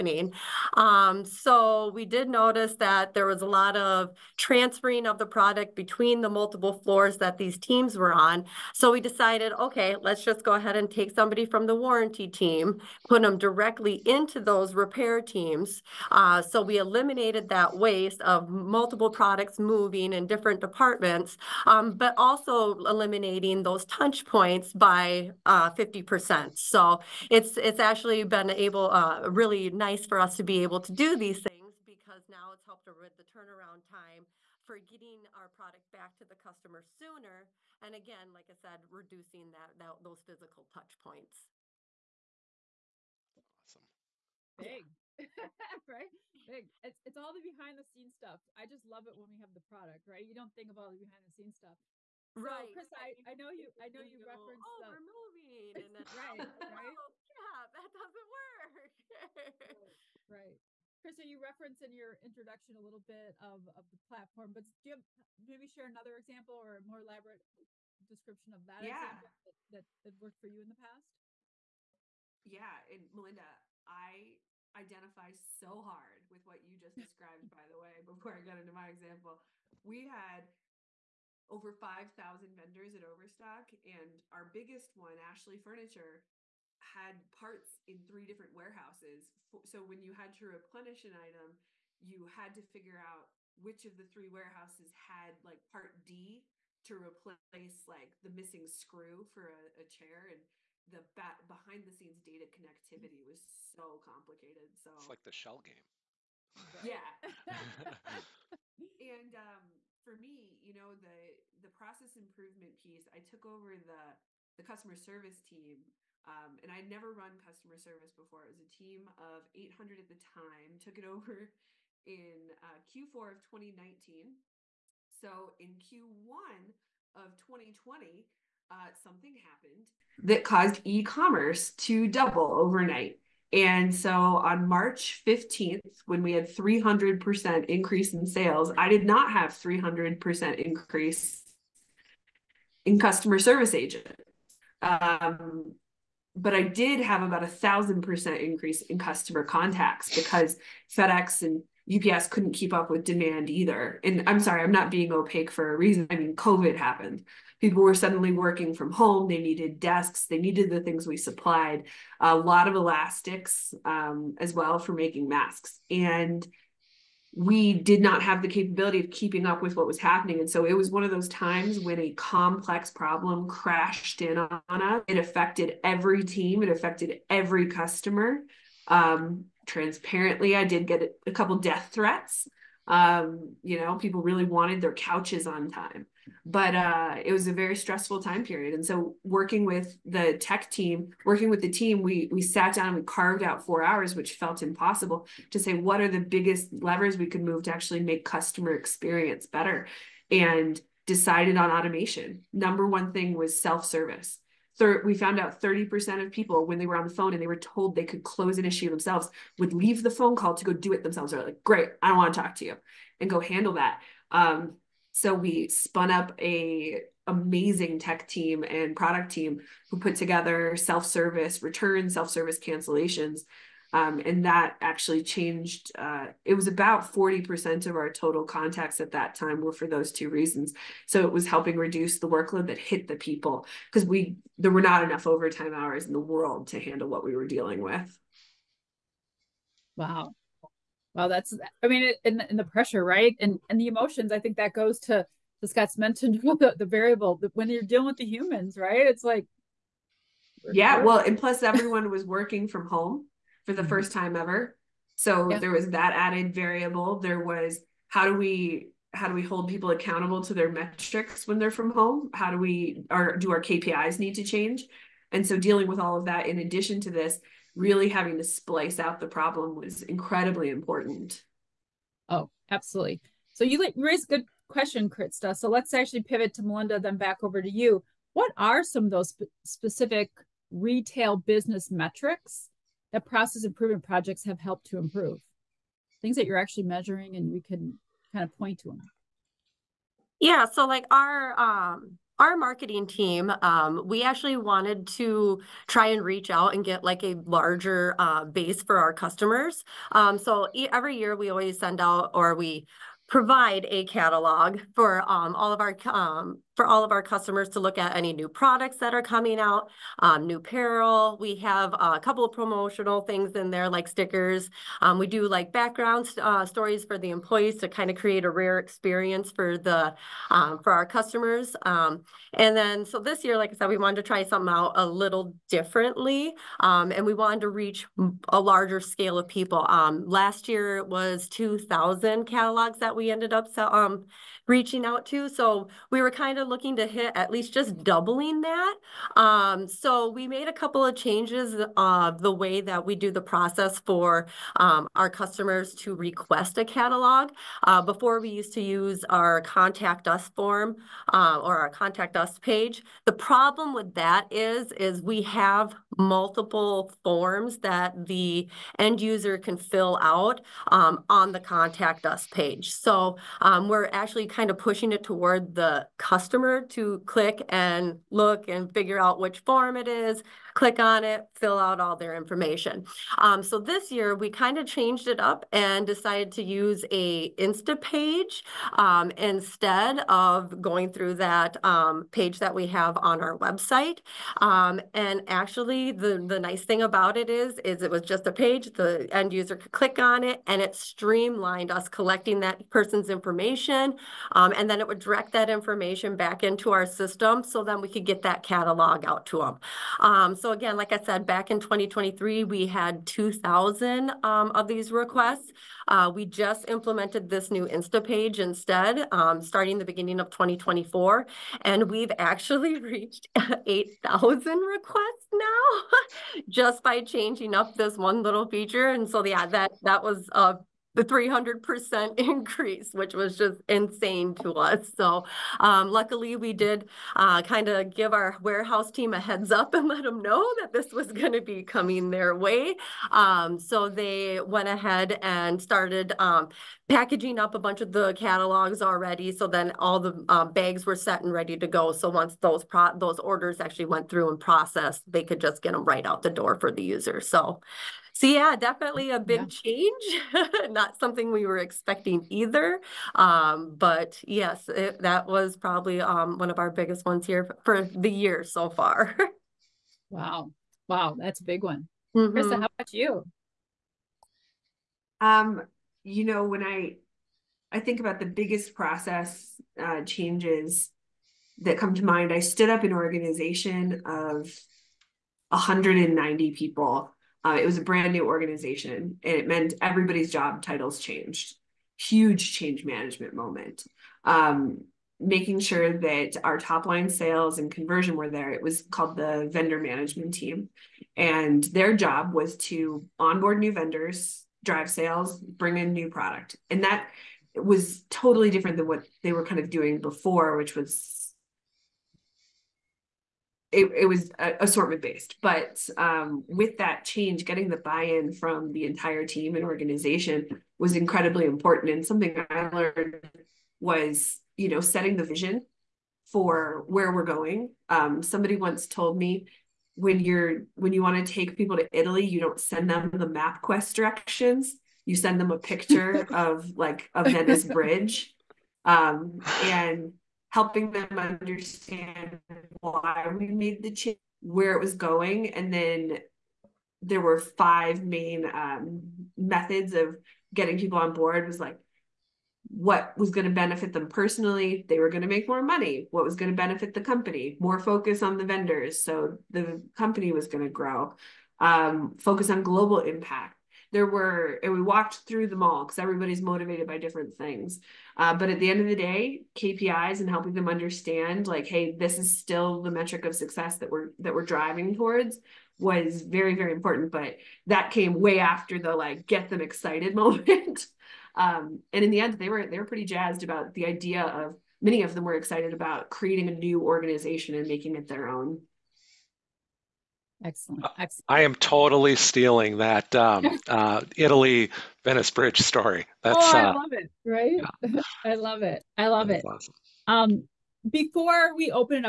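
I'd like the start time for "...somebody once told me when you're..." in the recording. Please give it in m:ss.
8:38.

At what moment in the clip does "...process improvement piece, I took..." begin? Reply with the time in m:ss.
1:51.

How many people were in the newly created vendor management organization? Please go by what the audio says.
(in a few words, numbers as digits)
190.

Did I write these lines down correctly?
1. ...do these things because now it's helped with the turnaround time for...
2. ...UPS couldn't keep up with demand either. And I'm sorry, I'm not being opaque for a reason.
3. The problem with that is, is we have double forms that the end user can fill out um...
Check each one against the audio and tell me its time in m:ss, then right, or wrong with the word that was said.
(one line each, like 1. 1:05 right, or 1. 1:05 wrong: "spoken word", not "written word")
1. 0:30 right
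2. 2:31 right
3. 5:53 wrong: "multiple", not "double".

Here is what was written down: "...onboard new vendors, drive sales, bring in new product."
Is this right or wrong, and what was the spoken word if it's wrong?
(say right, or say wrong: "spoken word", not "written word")
right.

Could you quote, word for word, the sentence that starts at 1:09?
that, that, that worked for you in the past?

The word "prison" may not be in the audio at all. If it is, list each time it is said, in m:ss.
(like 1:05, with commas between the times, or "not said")
not said.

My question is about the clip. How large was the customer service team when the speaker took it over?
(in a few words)
800.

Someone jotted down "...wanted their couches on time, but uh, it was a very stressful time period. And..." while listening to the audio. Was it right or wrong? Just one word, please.
right.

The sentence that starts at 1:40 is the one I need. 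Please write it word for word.
And the bat- behind the scenes data mm.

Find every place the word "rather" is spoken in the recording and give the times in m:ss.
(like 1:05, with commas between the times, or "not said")
not said.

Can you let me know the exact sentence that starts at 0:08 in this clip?
So we decided, okay, let's just go ahead and take somebody from the warranty team, put them directly into those repair teams.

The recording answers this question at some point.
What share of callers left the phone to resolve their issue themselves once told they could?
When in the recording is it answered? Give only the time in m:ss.
3:25.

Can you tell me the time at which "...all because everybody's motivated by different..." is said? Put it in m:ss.
9:15.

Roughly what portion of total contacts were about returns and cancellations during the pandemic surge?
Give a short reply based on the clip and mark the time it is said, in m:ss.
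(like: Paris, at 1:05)
40%, at 3:47.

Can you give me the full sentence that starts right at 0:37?
And again, like I said, reducing that, that those physical touch points.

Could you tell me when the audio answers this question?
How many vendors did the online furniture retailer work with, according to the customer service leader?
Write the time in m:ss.
1:21.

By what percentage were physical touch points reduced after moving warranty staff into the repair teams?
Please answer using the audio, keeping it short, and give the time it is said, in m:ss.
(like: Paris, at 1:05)
50%, at 0:25.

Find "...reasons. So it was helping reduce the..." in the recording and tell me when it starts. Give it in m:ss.
3:50.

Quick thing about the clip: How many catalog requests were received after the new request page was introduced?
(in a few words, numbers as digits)
8,000.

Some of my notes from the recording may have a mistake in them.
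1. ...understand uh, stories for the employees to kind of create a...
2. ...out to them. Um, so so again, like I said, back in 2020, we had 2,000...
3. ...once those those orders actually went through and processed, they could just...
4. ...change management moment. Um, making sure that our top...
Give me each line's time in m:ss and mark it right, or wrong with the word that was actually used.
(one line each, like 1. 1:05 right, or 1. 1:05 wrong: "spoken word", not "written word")
1. 5:15 wrong: "background", not "understand"
2. 6:39 wrong: "2023", not "2020"
3. 7:22 right
4. 8:02 right.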